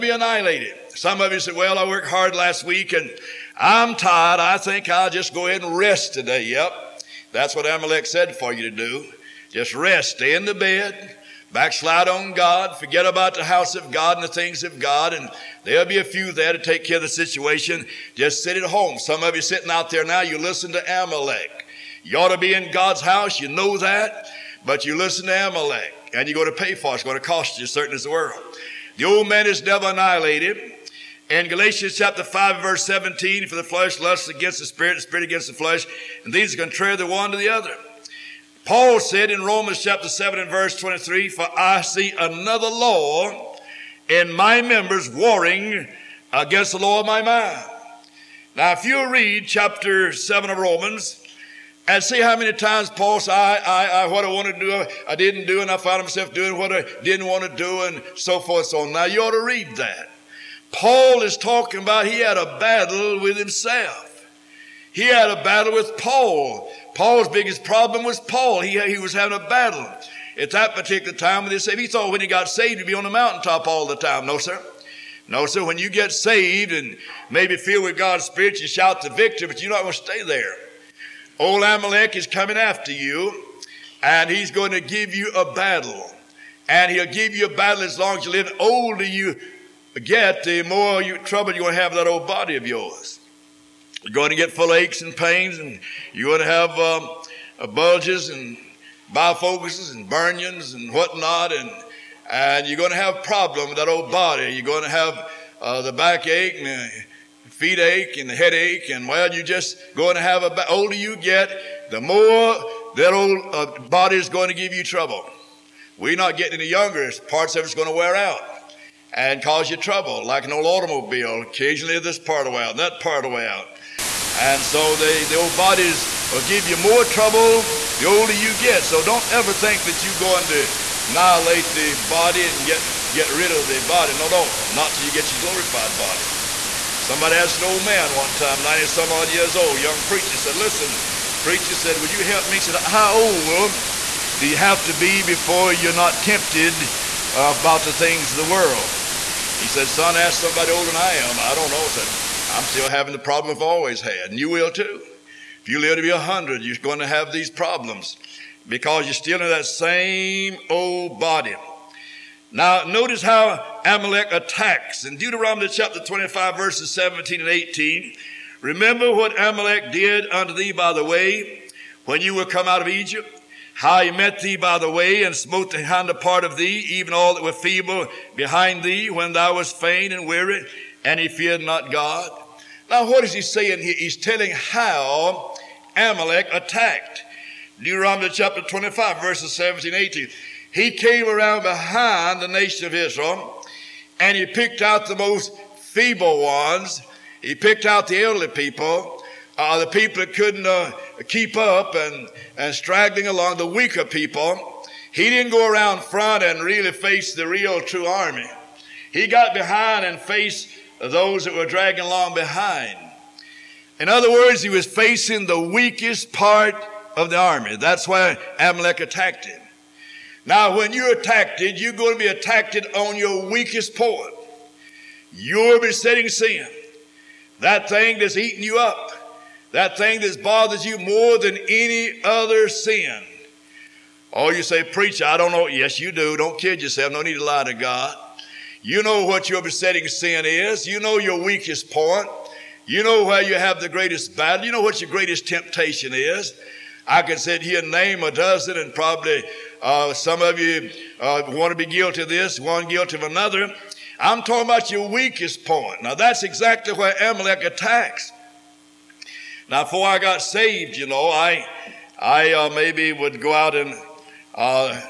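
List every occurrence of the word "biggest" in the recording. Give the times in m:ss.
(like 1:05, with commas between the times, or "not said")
1:07.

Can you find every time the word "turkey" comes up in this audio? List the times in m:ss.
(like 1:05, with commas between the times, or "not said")
not said.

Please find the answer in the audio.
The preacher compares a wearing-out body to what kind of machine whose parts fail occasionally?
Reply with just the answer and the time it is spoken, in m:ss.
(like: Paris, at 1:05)
An old automobile, at 2:00.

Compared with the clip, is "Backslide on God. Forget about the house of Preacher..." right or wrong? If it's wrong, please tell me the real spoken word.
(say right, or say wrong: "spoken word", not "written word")
wrong: "God", not "Preacher".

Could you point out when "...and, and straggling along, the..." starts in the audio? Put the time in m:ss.
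3:21.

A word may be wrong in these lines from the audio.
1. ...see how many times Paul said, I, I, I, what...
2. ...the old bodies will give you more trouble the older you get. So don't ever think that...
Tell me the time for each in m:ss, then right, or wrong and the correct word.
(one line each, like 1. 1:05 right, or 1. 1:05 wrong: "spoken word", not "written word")
1. 0:52 right
2. 2:05 right.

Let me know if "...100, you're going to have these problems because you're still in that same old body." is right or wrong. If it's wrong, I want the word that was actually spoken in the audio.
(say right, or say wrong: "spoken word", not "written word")
right.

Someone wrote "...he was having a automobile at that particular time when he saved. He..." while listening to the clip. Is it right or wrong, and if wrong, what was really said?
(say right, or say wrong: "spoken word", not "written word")
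wrong: "battle", not "automobile".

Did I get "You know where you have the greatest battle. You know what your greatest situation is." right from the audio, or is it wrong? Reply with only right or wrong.
wrong.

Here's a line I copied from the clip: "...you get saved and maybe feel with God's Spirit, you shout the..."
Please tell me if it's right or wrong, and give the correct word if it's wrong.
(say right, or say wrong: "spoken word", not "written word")
right.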